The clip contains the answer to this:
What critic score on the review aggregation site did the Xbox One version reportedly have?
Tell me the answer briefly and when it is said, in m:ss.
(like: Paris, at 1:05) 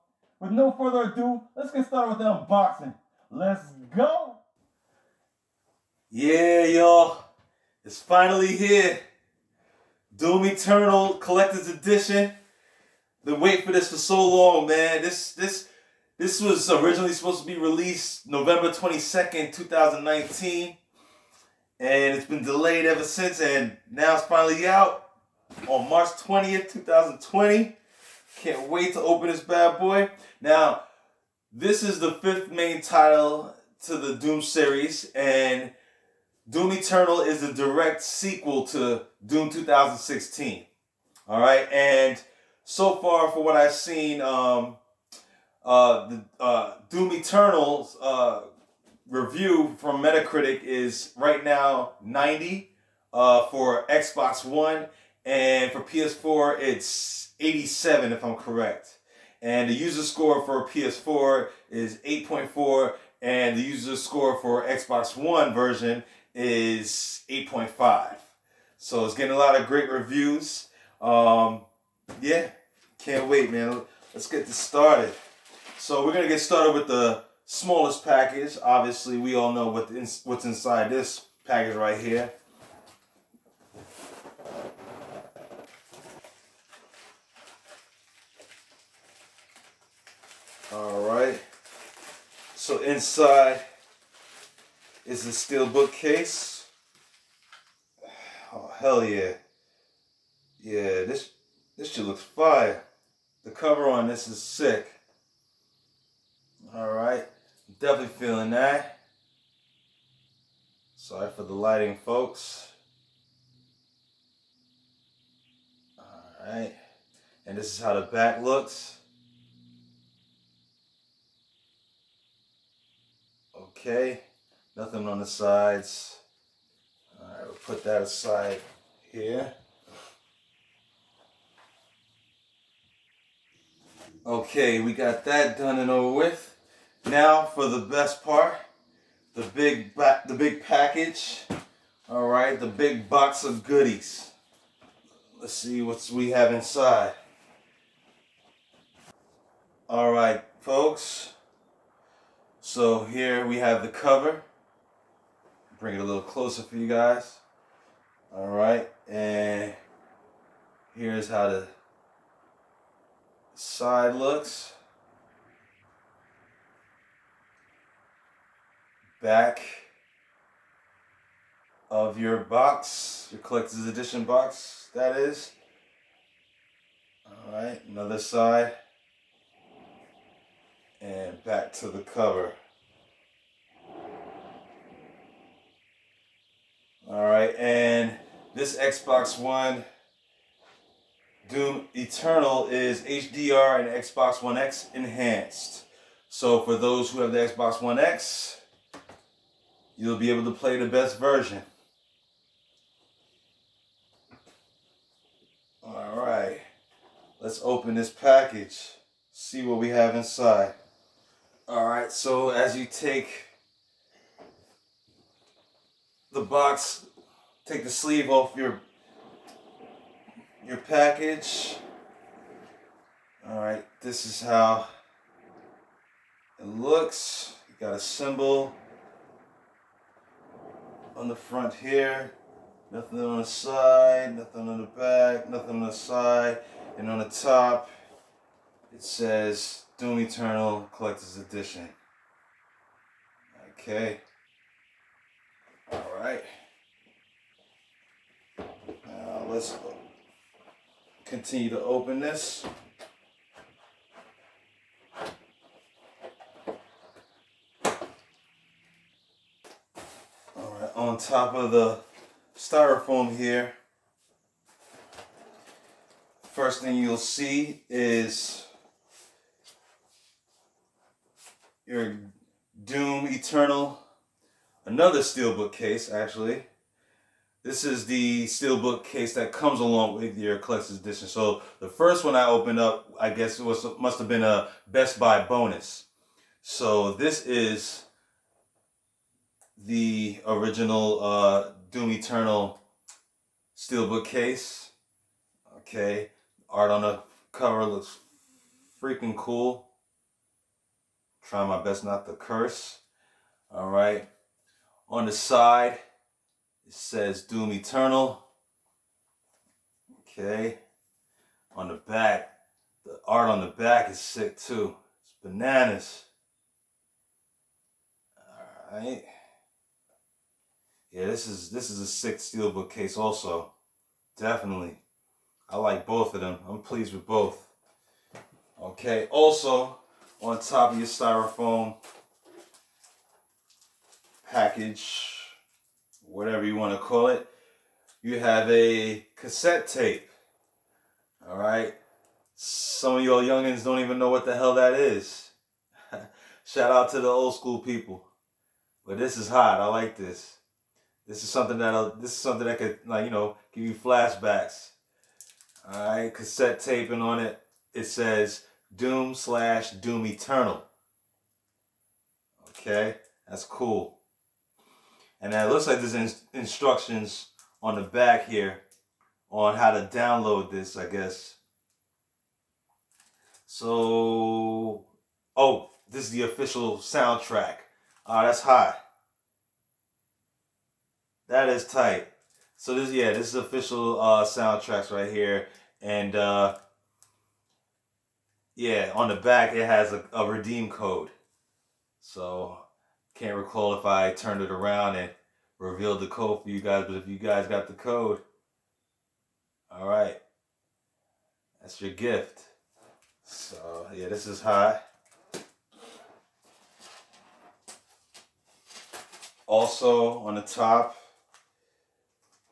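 90, at 0:52.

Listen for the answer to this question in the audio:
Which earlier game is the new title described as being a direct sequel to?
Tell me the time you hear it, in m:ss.
0:39.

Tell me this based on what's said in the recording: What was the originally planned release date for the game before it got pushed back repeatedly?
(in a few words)
November 22nd, 2019.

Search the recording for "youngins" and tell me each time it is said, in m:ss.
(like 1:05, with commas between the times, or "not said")
5:43.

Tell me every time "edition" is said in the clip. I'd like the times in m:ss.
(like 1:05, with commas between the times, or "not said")
0:11, 2:53, 4:01, 4:40.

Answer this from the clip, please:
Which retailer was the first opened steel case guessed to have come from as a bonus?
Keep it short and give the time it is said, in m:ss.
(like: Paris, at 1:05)
Best Buy, at 4:44.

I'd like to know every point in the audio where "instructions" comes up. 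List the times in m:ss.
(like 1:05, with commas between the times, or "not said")
6:06.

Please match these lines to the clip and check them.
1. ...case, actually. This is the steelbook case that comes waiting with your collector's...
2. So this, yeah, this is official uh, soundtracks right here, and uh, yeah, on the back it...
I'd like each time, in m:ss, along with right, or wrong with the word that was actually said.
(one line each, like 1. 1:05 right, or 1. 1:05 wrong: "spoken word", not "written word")
1. 4:35 wrong: "along", not "waiting"
2. 6:22 right.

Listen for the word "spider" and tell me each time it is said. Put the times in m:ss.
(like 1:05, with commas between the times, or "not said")
not said.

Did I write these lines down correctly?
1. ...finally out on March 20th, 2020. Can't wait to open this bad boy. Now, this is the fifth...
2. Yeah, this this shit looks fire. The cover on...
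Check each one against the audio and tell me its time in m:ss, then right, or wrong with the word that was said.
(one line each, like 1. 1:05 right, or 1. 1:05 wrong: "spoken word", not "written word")
1. 0:24 right
2. 1:40 right.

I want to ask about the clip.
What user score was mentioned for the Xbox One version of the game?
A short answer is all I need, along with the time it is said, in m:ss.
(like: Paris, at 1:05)
8.5, at 1:07.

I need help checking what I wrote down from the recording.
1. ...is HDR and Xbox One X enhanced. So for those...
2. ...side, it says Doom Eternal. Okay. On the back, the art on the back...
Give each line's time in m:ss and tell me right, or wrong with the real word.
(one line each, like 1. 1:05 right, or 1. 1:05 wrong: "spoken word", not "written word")
1. 3:12 right
2. 5:05 right.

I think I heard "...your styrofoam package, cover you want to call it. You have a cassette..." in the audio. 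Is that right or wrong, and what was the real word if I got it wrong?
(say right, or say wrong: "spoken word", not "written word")
wrong: "whatever", not "cover".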